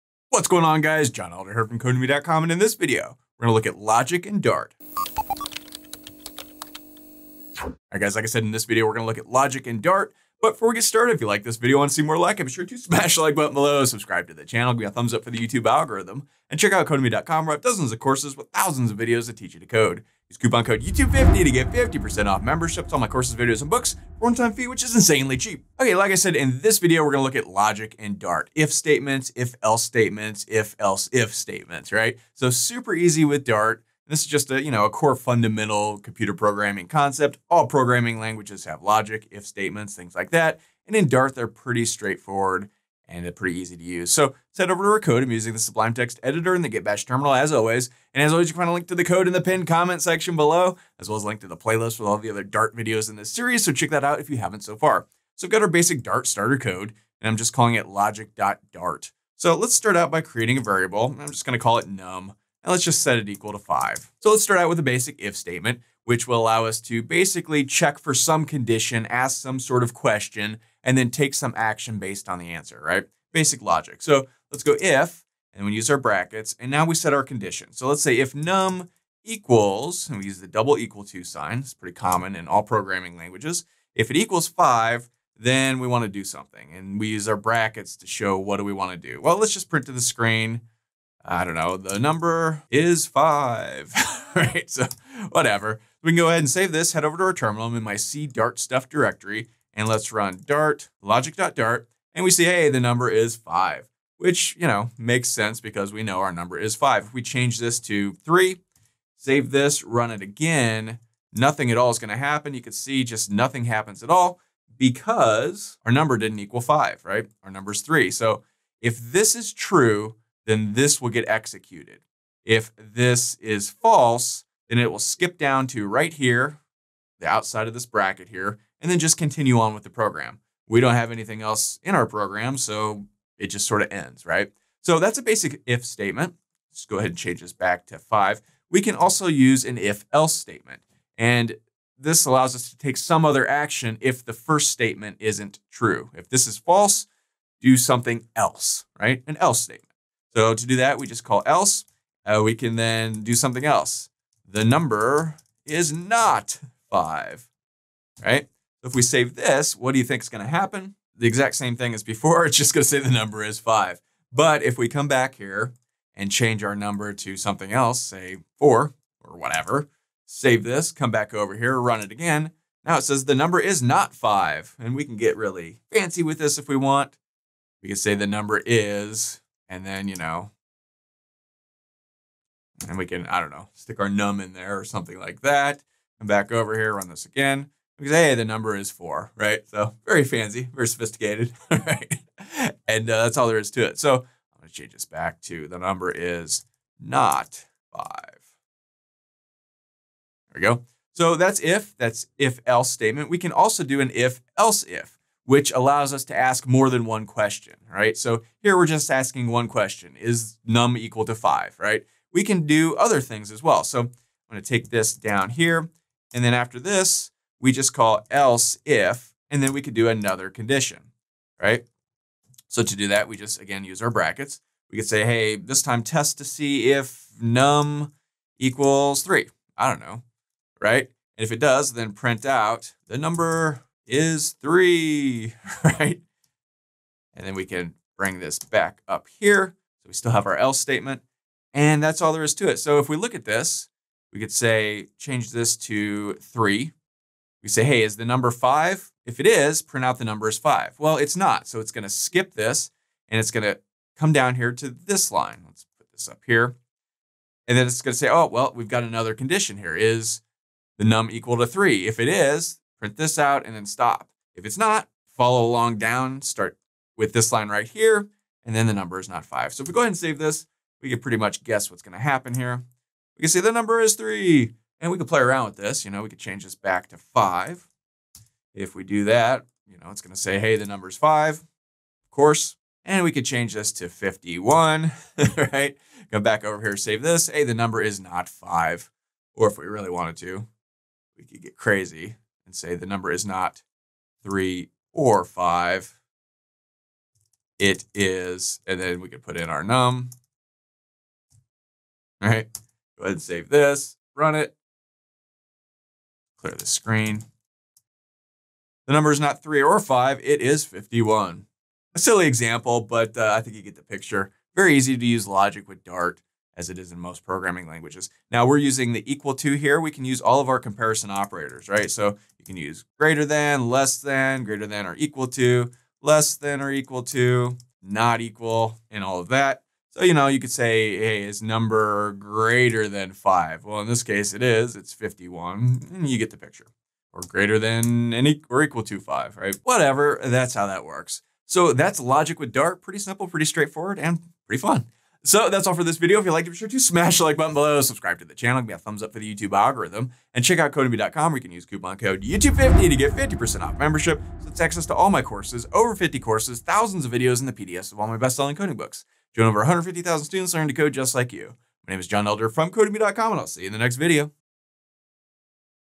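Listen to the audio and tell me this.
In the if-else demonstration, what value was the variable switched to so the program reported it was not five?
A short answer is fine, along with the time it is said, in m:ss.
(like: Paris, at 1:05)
4, at 2:48.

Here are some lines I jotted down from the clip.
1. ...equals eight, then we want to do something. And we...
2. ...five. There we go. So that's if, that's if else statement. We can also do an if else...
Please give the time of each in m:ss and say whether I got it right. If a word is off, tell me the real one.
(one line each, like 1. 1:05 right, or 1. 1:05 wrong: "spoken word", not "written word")
1. 1:24 wrong: "five", not "eight"
2. 3:17 right.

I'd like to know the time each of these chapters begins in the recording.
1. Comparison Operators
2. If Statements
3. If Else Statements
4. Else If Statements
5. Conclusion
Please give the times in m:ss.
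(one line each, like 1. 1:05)
1. 5:18
2. 1:00
3. 2:18
4. 3:23
5. 5:41.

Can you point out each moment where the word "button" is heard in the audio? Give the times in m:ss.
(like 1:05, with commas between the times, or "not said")
0:13, 5:47.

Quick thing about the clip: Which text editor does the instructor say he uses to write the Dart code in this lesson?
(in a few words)
Sublime Text.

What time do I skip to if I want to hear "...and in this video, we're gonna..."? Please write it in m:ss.
0:02.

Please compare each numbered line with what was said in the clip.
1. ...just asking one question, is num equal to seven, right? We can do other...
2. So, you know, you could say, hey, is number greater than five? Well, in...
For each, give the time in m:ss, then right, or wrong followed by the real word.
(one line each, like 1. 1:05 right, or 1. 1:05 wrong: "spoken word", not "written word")
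1. 3:28 wrong: "five", not "seven"
2. 5:30 right.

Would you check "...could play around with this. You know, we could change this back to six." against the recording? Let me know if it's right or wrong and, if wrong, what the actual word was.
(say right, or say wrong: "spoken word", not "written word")
wrong: "five", not "six".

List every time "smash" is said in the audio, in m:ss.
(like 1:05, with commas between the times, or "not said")
0:12, 5:46.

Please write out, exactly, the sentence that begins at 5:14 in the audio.
Very easy to use logic with Dart as it is in most programming languages.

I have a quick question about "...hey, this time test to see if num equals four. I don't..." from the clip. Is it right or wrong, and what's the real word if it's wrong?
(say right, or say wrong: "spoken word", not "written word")
wrong: "three", not "four".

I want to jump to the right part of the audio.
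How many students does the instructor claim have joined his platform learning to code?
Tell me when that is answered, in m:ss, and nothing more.
5:59.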